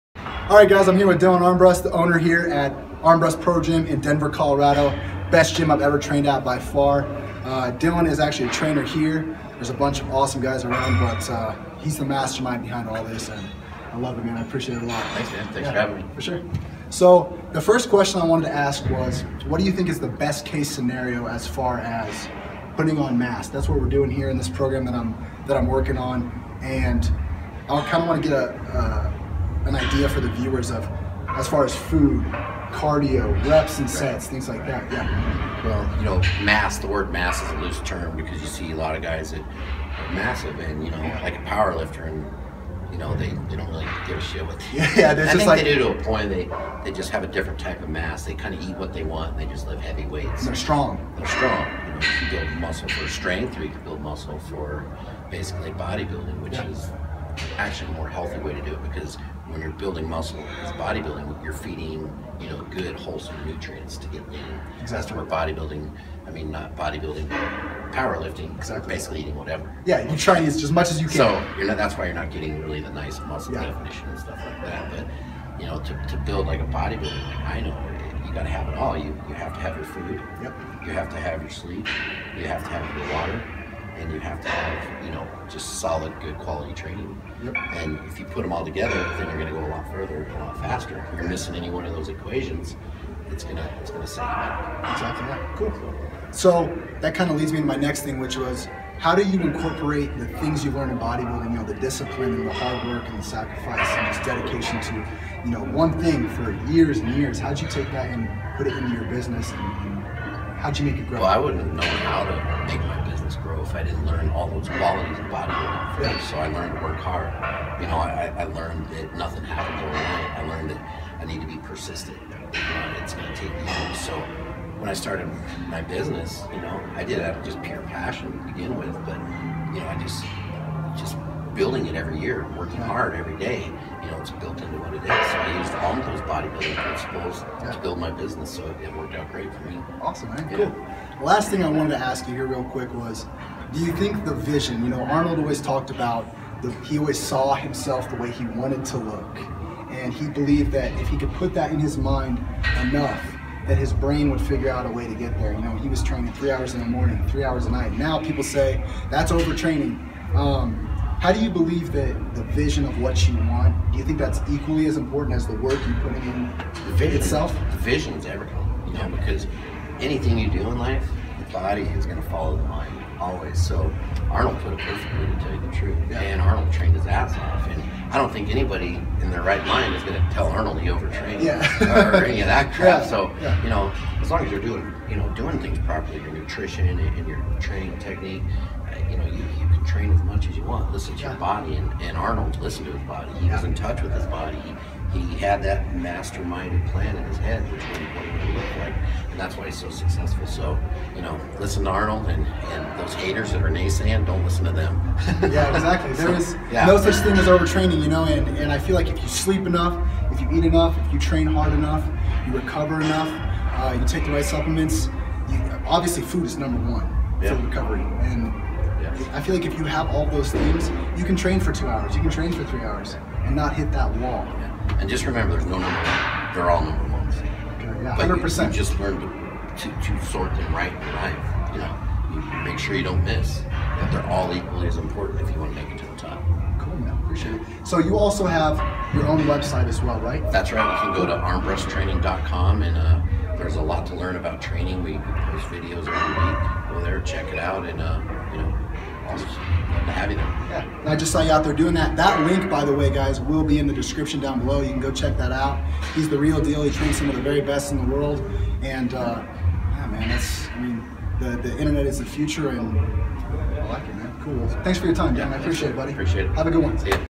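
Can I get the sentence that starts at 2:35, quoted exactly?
You know, he was training three hours in the morning, three hours a night.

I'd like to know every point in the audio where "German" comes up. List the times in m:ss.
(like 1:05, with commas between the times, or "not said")
not said.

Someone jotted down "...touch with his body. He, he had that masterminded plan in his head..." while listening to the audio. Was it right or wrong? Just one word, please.
right.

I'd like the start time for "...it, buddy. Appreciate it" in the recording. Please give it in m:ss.
4:25.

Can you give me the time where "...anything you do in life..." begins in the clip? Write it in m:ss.
2:49.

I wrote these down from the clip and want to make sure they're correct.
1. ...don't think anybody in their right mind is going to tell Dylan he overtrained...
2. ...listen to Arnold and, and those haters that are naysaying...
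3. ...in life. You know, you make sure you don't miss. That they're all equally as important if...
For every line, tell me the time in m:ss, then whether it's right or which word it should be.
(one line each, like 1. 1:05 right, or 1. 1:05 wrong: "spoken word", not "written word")
1. 2:58 wrong: "Arnold", not "Dylan"
2. 3:21 right
3. 3:50 right.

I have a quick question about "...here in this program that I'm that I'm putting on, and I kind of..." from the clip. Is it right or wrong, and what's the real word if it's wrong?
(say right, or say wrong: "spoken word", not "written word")
wrong: "working", not "putting".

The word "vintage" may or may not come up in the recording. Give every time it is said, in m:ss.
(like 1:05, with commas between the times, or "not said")
not said.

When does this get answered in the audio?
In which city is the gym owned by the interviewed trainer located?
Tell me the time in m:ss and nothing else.
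0:04.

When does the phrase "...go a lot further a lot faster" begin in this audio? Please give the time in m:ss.
1:29.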